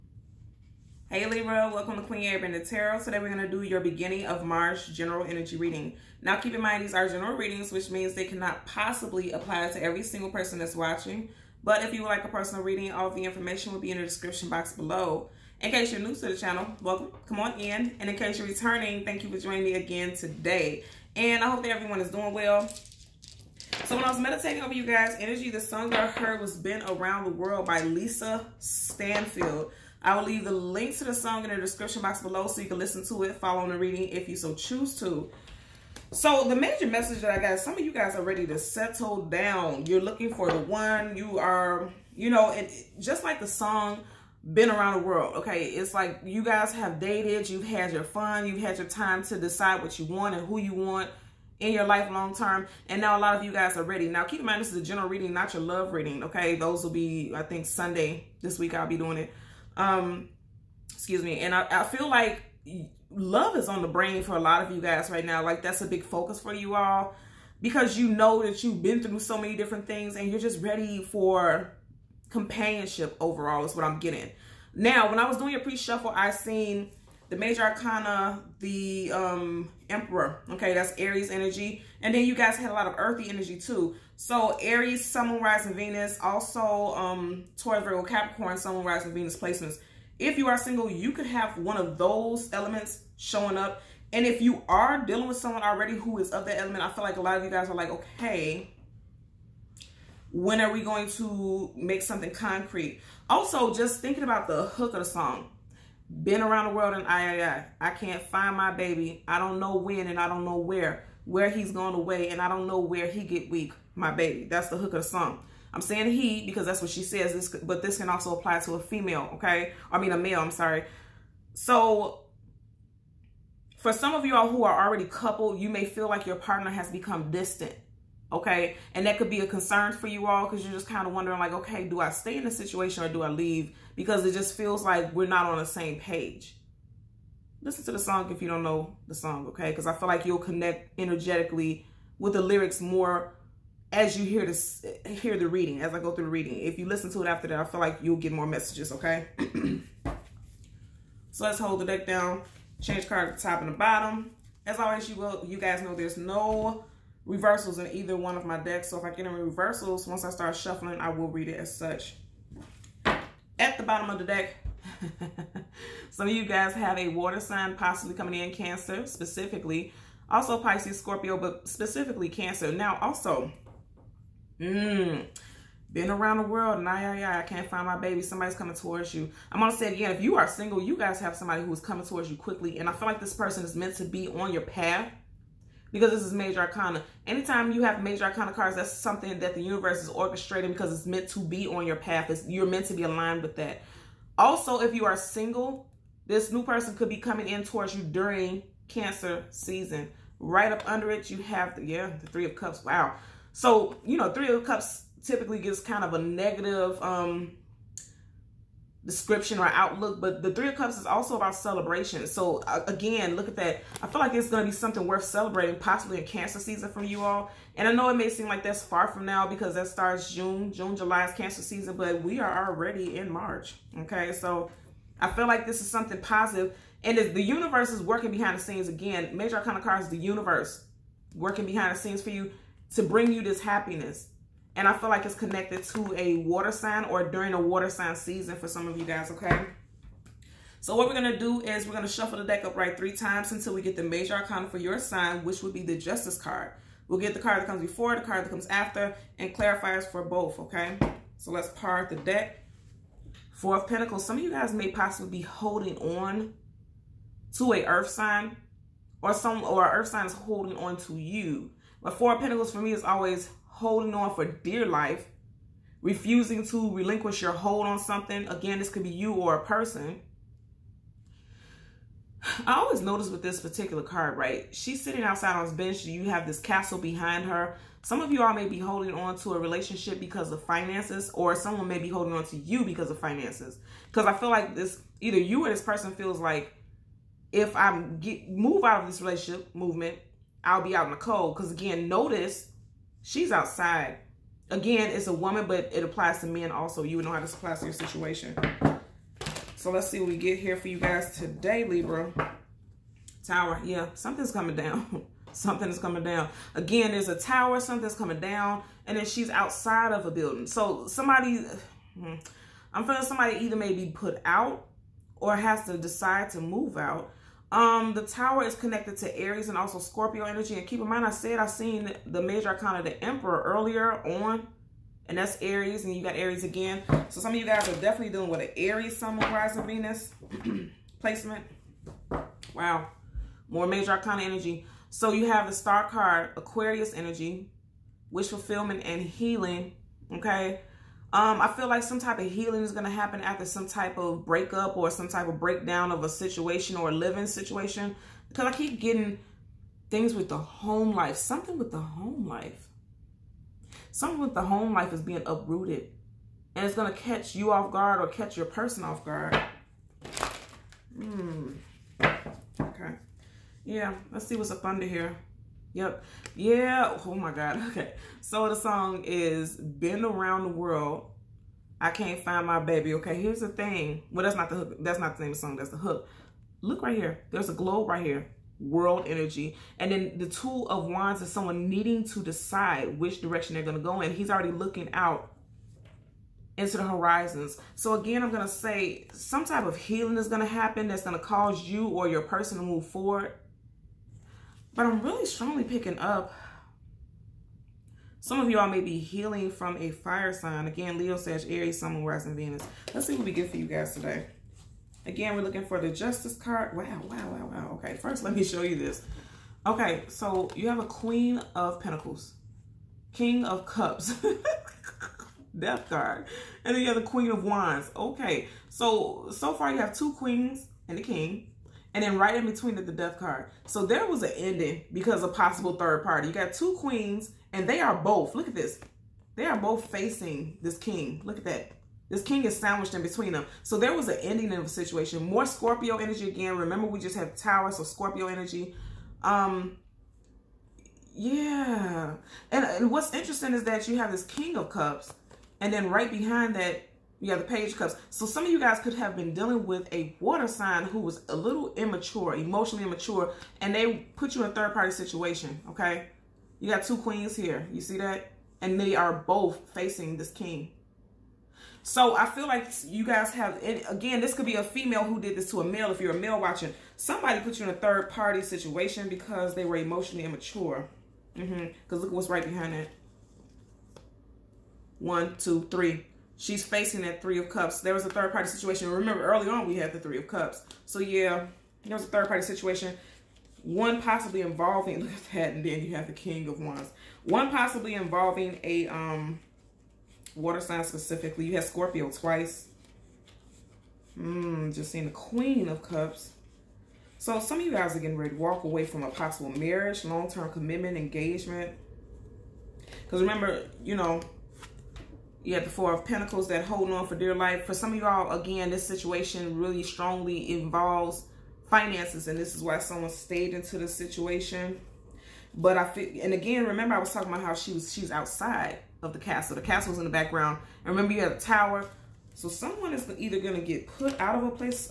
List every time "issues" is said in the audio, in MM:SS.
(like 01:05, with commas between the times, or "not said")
not said.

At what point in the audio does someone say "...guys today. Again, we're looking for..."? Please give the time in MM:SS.
06:43.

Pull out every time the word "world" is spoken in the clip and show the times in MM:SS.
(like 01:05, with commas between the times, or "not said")
00:27, 00:45, 01:46, 02:56, 06:10, 06:18.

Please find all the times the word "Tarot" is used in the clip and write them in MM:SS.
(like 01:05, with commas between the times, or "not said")
00:02.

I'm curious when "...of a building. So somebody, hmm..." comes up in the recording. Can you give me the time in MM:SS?
05:10.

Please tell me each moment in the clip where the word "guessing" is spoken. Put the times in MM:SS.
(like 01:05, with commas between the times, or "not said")
not said.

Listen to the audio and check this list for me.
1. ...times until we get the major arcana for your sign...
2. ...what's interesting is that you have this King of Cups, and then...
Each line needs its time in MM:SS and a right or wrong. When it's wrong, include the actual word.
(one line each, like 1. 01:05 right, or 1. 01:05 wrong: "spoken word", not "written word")
1. 04:03 right
2. 07:23 right.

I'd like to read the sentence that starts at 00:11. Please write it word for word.
But if you would like a personal reading, all the information will be in the description box below.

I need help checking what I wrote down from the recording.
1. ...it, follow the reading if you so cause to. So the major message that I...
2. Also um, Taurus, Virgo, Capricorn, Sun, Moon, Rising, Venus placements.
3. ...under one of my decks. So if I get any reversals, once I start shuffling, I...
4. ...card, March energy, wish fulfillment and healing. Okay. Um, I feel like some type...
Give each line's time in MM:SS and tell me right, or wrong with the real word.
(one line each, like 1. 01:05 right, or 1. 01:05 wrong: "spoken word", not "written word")
1. 00:33 wrong: "choose", not "cause"
2. 01:26 right
3. 02:37 wrong: "either", not "under"
4. 05:36 wrong: "Aquarius", not "March".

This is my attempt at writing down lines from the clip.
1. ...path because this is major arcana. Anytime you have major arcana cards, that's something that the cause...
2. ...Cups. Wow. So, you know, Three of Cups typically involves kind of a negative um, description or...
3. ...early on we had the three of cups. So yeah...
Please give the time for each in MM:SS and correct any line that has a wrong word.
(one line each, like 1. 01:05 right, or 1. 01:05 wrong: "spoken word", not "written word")
1. 03:04 wrong: "universe", not "cause"
2. 03:22 wrong: "gives", not "involves"
3. 07:59 right.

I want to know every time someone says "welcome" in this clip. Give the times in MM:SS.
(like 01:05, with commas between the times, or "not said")
00:01, 00:16.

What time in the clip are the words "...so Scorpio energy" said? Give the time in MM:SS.
07:17.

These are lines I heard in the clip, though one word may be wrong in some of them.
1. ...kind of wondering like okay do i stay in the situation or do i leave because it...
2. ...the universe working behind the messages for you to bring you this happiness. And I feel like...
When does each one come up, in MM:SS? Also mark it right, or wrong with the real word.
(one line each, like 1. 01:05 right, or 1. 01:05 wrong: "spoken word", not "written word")
1. 02:10 right
2. 03:50 wrong: "scenes", not "messages".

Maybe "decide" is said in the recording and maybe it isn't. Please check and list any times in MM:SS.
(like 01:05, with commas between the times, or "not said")
00:49, 05:15, 06:22.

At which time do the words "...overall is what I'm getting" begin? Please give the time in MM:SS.
01:13.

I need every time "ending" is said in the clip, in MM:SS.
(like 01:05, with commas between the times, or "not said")
07:04, 07:14.